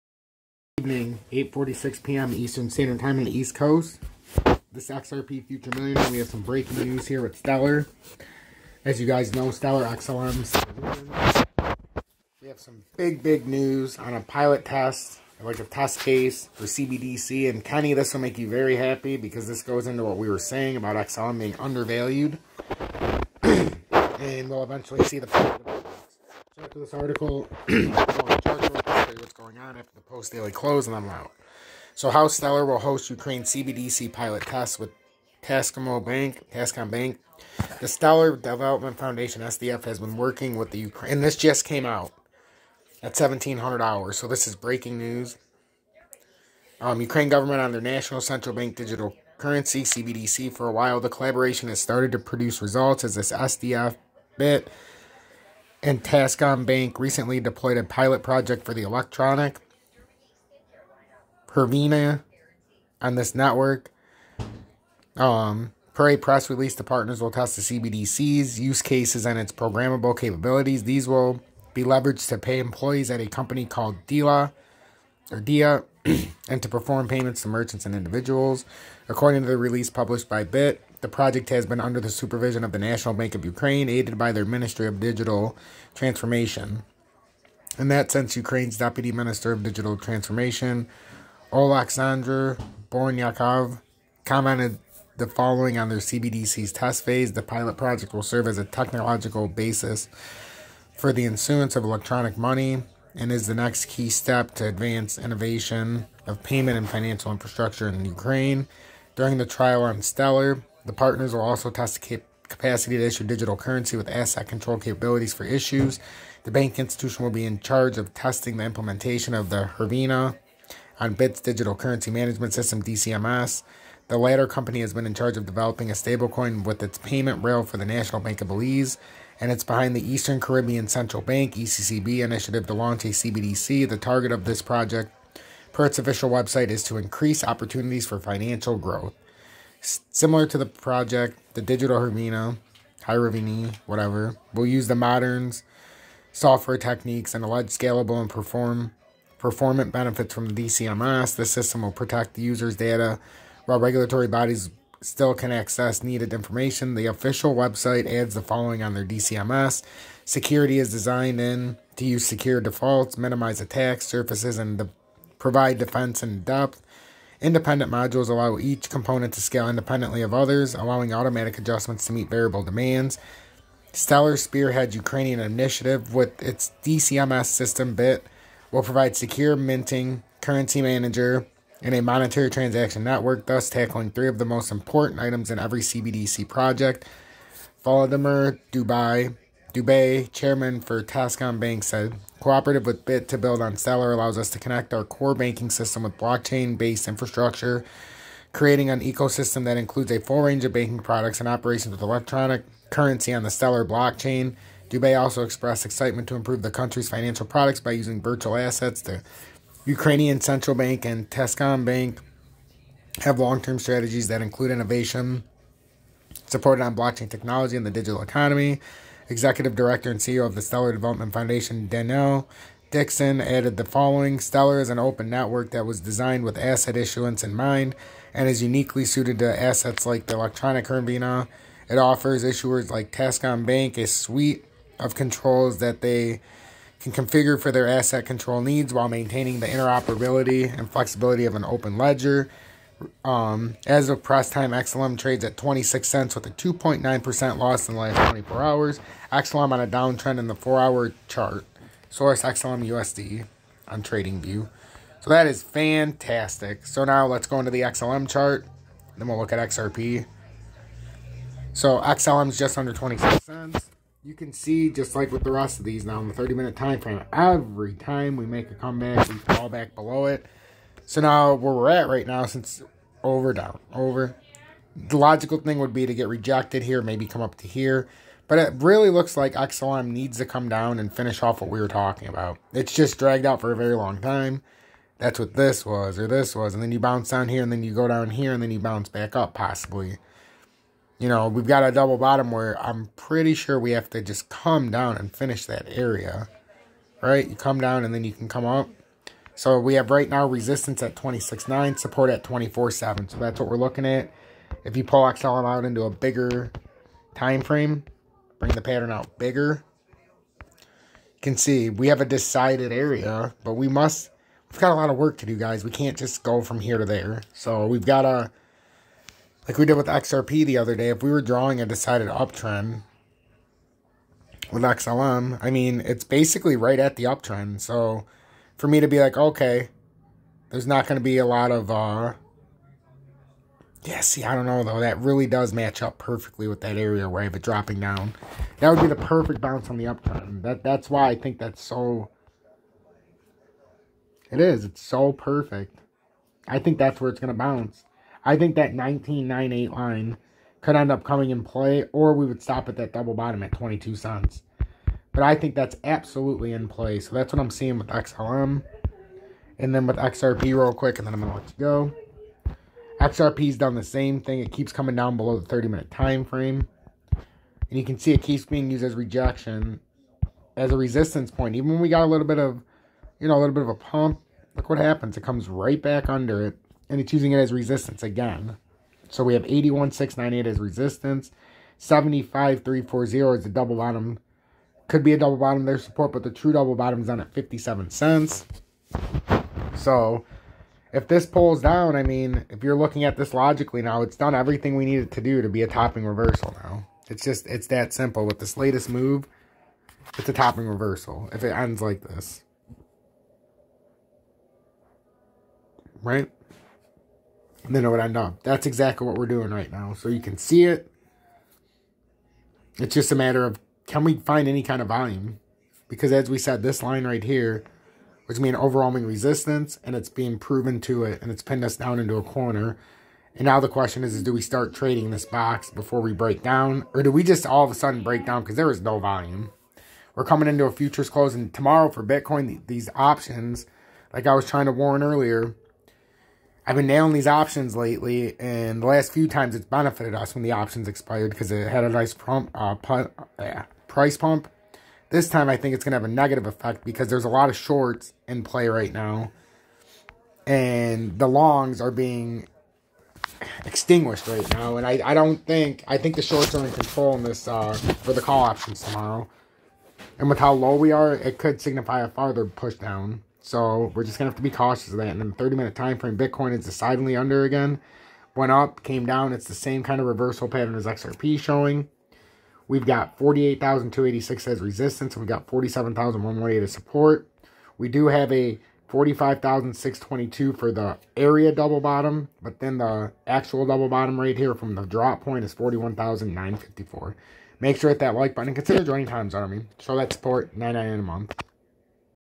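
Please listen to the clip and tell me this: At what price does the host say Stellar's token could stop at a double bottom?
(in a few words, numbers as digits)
22 cents.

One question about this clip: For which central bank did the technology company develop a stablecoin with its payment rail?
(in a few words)
National Bank of Belize.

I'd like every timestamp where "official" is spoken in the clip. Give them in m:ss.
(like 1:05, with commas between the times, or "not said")
2:15, 2:37.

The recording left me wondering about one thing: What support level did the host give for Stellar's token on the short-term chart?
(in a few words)
24.7.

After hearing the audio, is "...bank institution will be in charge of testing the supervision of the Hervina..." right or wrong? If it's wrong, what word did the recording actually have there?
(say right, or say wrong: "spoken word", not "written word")
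wrong: "implementation", not "supervision".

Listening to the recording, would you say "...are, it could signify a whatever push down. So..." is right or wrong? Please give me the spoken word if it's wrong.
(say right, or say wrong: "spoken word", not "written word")
wrong: "farther", not "whatever".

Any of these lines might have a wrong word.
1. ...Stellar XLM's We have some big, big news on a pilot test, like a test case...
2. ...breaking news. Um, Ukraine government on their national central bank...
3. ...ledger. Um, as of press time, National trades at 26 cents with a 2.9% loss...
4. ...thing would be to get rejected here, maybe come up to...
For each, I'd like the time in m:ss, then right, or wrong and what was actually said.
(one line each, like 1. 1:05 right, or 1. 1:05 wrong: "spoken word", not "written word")
1. 0:09 right
2. 0:44 right
3. 4:01 wrong: "XLM", not "National"
4. 4:35 right.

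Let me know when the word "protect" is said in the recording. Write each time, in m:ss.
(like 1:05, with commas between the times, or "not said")
2:31.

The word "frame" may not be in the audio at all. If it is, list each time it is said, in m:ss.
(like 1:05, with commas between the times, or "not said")
4:26, 5:07, 6:06, 7:46.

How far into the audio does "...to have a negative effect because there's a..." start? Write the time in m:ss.
7:26.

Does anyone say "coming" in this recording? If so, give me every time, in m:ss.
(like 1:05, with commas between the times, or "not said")
5:51, 6:04, 7:10.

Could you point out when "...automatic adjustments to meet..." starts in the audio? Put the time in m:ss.
2:51.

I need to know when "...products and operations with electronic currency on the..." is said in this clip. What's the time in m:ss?
3:20.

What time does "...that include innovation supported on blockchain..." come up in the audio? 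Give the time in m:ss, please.
3:34.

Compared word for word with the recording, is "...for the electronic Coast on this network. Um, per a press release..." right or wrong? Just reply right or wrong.
wrong.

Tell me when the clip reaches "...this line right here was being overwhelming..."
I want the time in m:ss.
6:56.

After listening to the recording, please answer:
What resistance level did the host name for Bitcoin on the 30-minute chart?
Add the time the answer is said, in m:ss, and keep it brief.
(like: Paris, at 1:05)
48,286, at 7:53.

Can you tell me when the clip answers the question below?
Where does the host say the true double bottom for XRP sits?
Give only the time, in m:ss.
6:27.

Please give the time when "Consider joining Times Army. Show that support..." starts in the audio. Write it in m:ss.
8:08.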